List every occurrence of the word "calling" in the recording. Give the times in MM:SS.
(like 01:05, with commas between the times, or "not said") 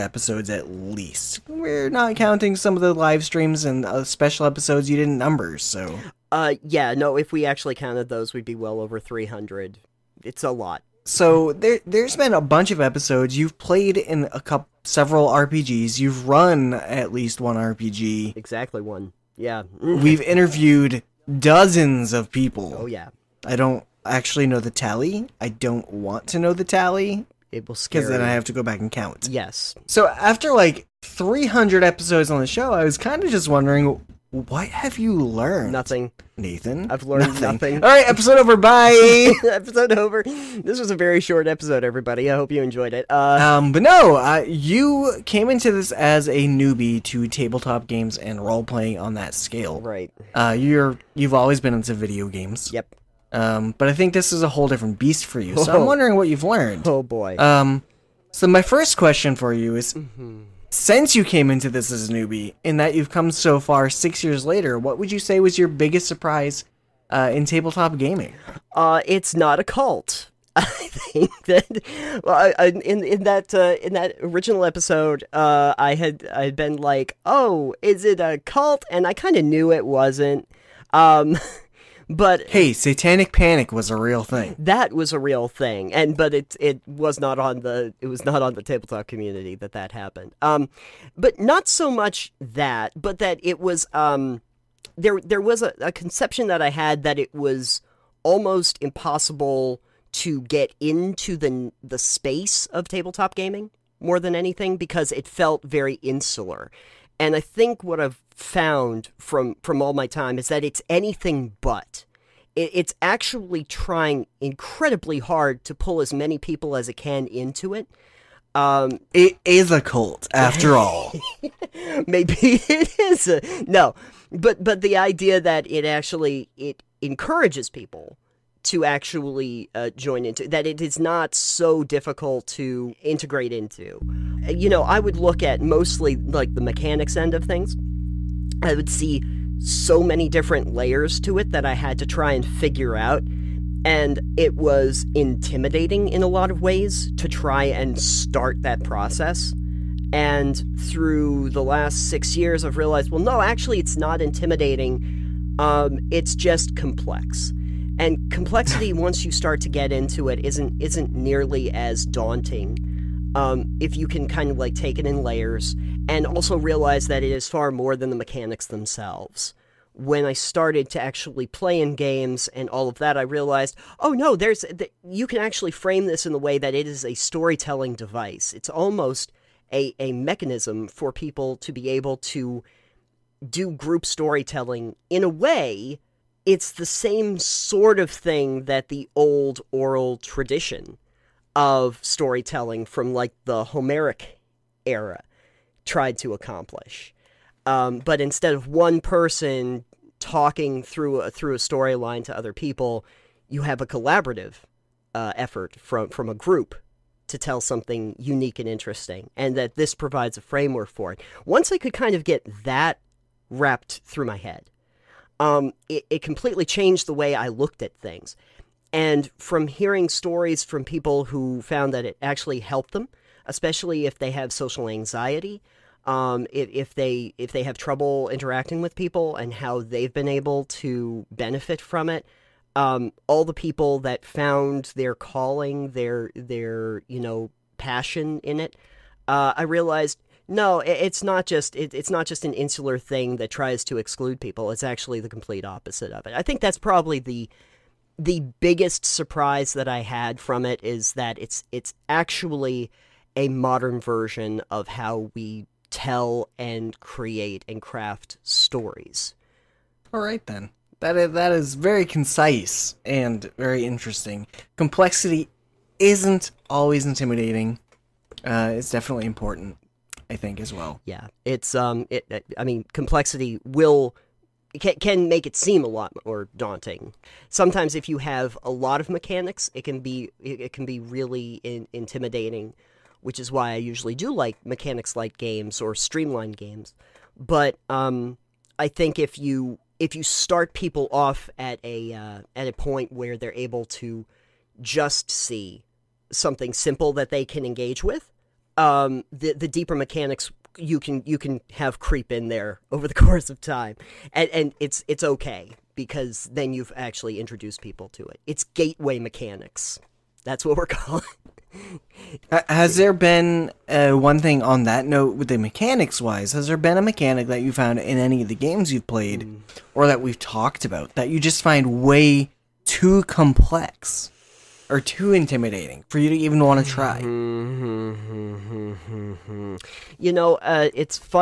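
03:55, 05:10.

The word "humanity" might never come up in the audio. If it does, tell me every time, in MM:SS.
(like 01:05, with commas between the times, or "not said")
not said.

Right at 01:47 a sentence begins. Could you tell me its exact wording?
And I think what I've found from from all my time is that it's anything but.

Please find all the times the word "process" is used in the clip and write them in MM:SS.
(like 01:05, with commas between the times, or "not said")
02:28.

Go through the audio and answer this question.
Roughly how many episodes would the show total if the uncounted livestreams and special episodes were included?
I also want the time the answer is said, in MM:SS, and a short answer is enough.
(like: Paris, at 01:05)
over 300, at 00:08.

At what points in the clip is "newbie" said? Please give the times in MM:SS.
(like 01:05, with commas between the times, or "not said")
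00:46, 01:02.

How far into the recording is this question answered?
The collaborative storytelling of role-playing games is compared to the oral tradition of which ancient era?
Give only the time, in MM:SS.
03:13.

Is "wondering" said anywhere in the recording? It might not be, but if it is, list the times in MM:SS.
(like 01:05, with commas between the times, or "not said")
00:33, 00:55.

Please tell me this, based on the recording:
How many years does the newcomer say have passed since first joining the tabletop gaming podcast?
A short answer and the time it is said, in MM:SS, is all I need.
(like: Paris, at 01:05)
6, at 01:03.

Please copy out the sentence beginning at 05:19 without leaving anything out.
or that we've talked about that you just find way too complex are too intimidating for you to even want to try.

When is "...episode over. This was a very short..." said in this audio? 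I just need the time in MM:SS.
00:39.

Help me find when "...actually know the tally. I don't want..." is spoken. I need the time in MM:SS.
00:24.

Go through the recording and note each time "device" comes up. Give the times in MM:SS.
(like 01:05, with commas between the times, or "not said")
02:57.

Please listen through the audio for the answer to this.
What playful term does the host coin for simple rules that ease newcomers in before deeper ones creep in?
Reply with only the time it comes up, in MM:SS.
05:08.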